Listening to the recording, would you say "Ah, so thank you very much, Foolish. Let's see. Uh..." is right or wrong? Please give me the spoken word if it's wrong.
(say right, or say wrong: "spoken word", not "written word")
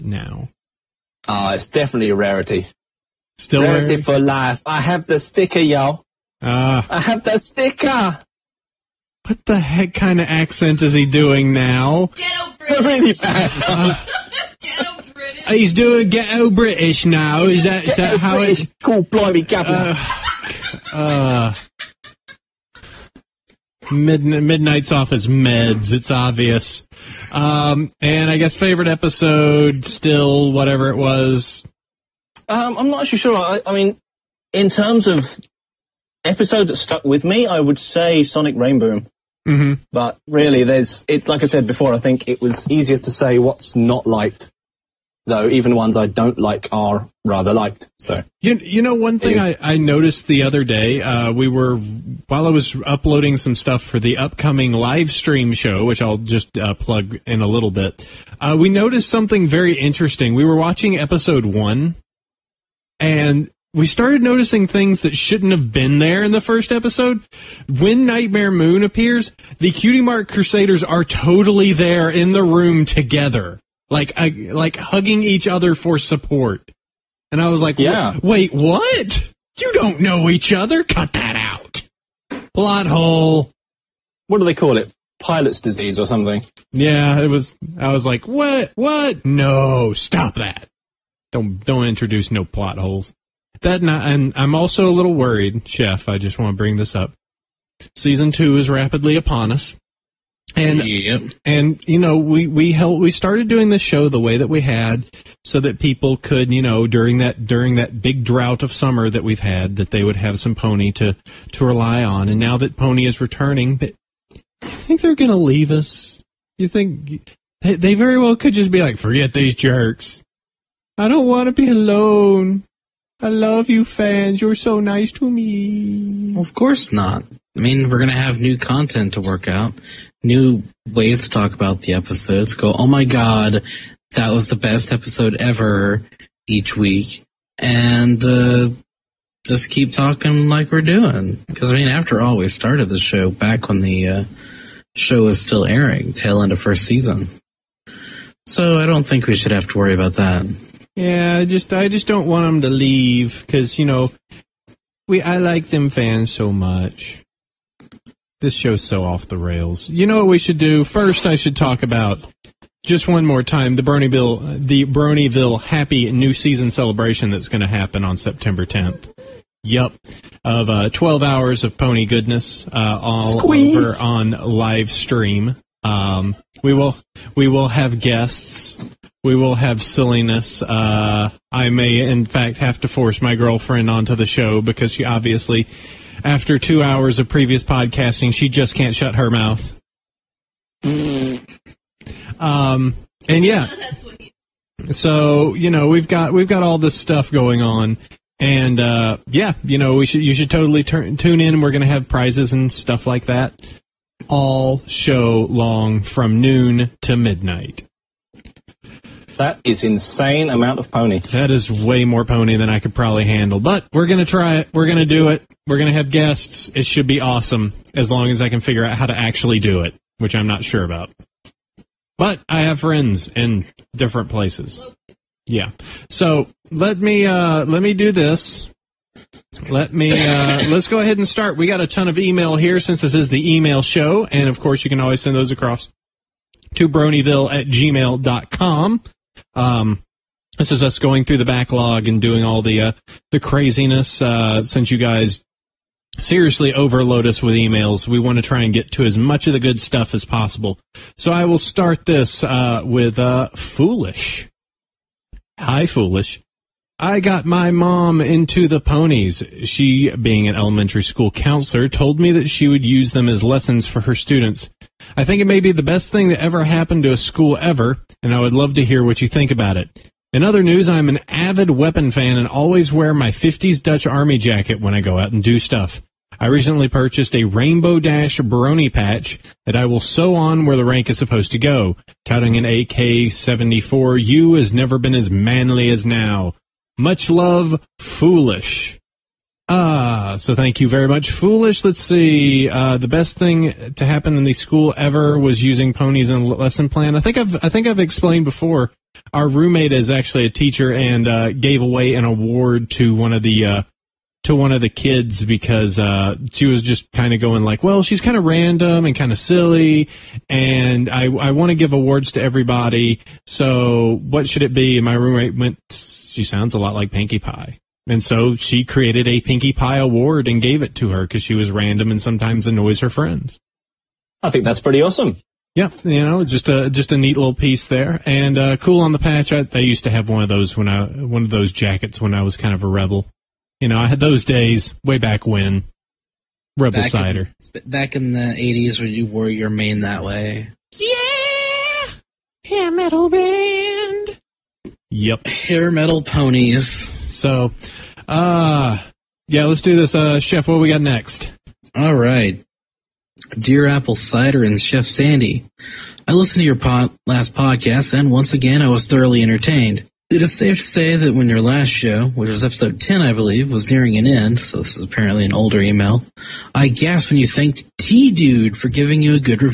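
right.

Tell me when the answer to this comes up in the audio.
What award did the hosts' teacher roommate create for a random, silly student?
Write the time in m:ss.
5:19.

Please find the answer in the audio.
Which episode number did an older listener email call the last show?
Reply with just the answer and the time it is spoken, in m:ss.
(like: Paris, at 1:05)
10, at 6:02.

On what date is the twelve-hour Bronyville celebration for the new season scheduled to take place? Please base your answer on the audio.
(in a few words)
September 10th.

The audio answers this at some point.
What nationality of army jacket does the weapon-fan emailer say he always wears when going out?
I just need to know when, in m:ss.
4:33.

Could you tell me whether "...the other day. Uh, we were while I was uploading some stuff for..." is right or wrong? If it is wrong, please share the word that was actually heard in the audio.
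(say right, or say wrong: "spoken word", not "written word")
right.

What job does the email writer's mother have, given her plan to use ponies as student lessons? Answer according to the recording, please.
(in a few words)
Elementary school counselor.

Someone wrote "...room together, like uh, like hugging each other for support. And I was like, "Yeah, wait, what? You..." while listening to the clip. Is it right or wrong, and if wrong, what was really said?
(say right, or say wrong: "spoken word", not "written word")
right.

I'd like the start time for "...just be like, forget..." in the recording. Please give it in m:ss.
1:58.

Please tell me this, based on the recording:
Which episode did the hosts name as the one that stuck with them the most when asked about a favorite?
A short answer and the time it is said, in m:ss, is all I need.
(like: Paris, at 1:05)
Sonic Rainboom, at 0:38.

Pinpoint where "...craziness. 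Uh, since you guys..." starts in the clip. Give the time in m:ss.
4:03.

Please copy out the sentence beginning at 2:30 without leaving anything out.
Yeah, I just I just don't want them to leave because you know we I like them fans so much.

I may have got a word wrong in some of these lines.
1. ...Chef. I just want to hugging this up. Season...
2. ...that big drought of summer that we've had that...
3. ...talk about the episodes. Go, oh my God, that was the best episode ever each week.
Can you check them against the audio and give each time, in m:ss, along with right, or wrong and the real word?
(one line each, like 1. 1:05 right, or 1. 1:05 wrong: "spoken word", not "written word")
1. 1:35 wrong: "bring", not "hugging"
2. 1:47 right
3. 2:11 right.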